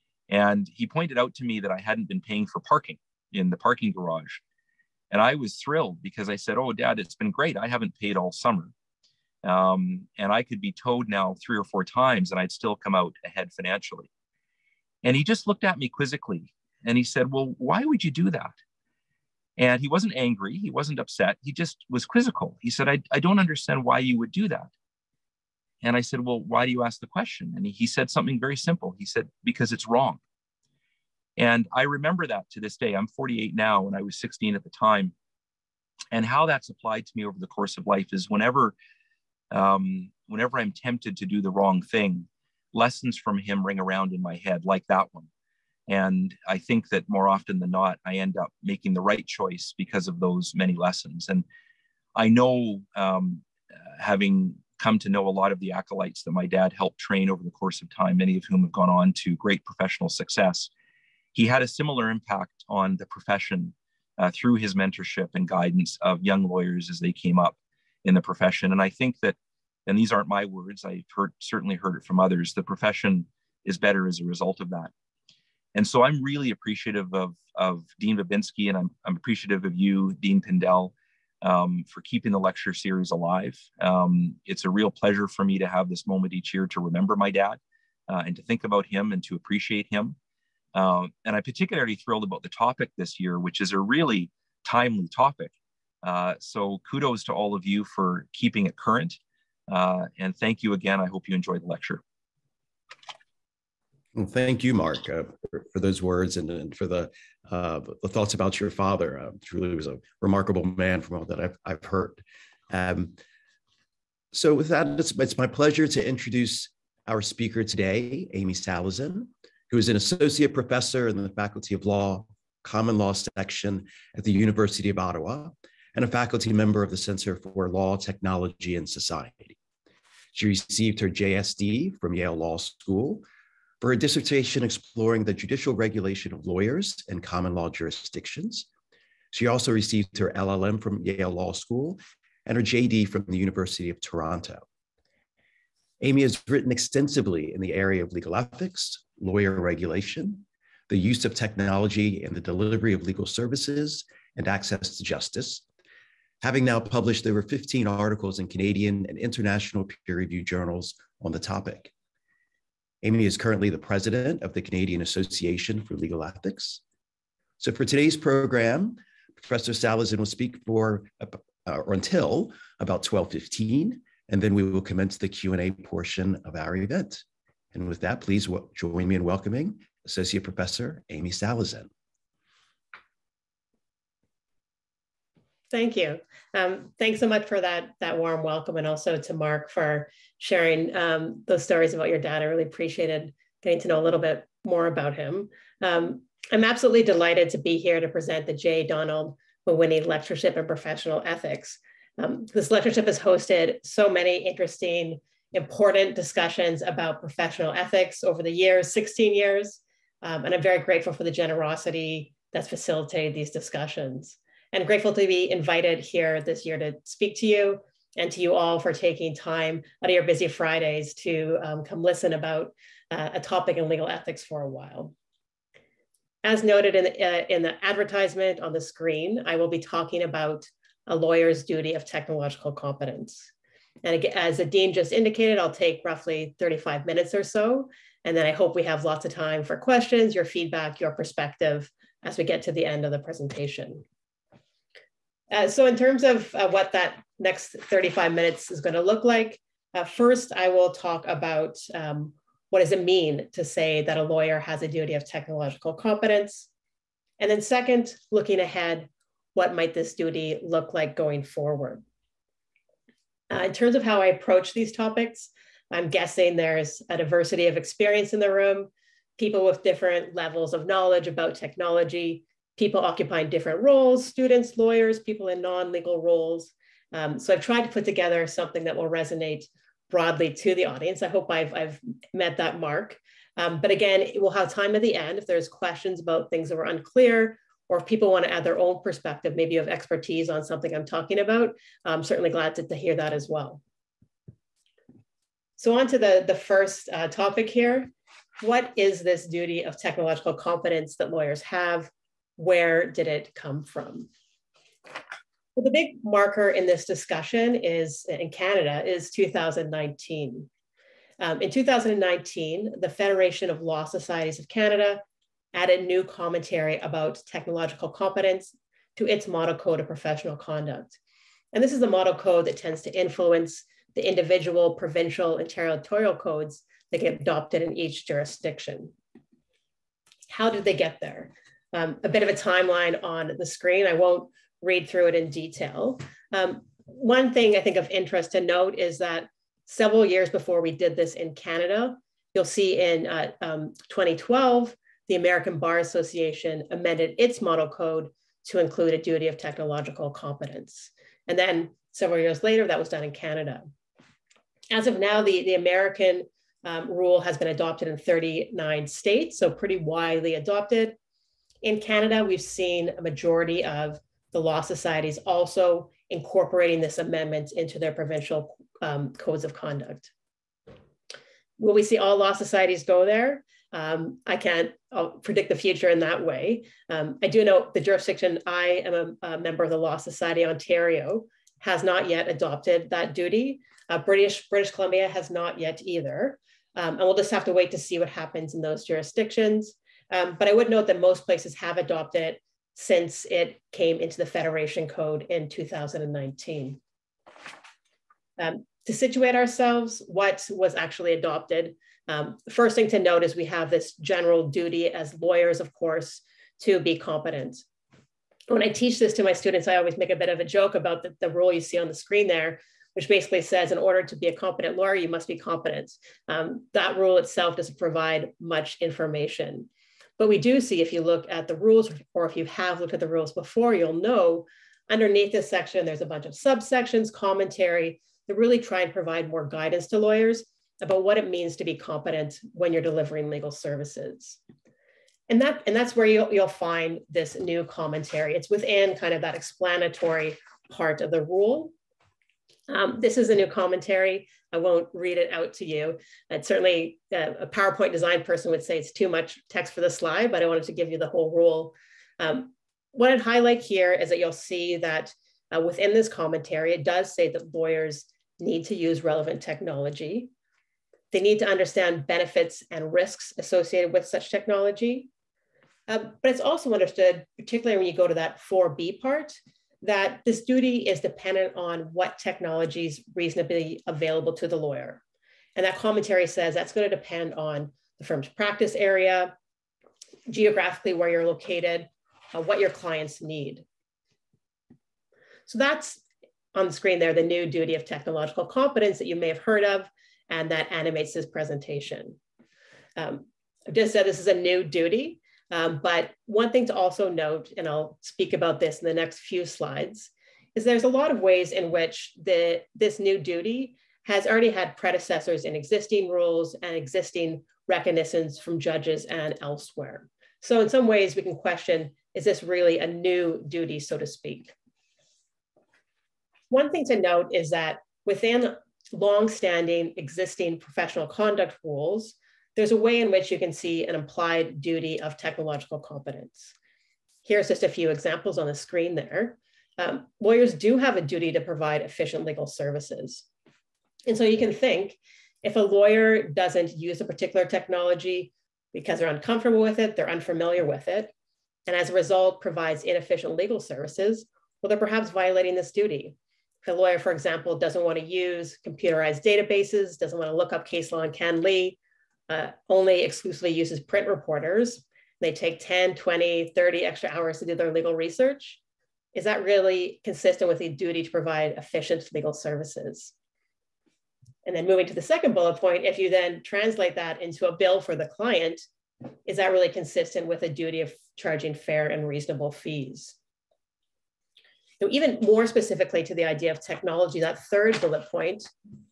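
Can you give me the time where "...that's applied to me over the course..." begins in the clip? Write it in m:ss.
0:36.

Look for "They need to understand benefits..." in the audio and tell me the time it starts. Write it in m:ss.
7:41.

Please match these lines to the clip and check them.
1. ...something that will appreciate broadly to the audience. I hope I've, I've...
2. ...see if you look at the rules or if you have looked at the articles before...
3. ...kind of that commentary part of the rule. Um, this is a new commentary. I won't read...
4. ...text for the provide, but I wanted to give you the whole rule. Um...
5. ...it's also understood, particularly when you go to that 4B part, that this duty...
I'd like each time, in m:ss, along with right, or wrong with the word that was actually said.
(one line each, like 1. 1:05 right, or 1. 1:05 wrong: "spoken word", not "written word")
1. 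4:38 wrong: "resonate", not "appreciate"
2. 7:00 wrong: "rules", not "articles"
3. 7:19 wrong: "explanatory", not "commentary"
4. 7:29 wrong: "slide", not "provide"
5. 7:46 right.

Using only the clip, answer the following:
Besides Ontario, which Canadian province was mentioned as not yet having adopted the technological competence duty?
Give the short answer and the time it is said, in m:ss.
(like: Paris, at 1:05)
British Columbia, at 6:24.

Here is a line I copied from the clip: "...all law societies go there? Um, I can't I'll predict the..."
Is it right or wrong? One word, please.
right.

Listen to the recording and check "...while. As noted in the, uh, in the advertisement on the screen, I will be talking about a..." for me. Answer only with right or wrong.
right.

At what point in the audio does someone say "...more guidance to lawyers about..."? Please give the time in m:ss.
7:09.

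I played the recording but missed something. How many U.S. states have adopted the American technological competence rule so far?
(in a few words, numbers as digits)
39.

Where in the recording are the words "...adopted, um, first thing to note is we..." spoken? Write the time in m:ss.
6:41.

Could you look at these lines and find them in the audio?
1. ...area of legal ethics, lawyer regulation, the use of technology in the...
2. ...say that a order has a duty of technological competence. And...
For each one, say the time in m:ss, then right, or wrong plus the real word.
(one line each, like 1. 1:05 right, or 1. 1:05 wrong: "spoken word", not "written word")
1. 2:27 right
2. 4:13 wrong: "lawyer", not "order".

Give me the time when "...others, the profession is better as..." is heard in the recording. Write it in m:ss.
1:12.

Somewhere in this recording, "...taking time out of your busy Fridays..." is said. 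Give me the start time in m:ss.
3:38.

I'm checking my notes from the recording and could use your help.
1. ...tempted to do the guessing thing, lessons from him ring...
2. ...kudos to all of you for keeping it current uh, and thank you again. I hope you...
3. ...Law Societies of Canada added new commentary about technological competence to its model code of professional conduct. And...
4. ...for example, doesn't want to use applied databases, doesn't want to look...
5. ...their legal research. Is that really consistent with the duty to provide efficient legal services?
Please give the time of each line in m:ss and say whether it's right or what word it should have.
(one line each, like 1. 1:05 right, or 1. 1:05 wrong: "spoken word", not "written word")
1. 0:40 wrong: "wrong", not "guessing"
2. 1:36 right
3. 5:13 right
4. 9:07 wrong: "computerized", not "applied"
5. 9:17 right.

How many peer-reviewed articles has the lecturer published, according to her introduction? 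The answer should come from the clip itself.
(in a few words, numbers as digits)
over 15.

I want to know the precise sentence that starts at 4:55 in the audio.
So on to the, the first uh, topic here.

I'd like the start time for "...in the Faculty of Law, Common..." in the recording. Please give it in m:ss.
2:01.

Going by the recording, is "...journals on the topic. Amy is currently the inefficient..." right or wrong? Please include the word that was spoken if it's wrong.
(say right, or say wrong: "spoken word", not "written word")
wrong: "president", not "inefficient".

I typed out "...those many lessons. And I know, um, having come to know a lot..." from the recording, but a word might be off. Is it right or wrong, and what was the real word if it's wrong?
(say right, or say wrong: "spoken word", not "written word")
right.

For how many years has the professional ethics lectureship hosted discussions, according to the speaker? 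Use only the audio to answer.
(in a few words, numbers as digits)
16 years.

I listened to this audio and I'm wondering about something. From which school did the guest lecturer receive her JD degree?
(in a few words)
University of Toronto.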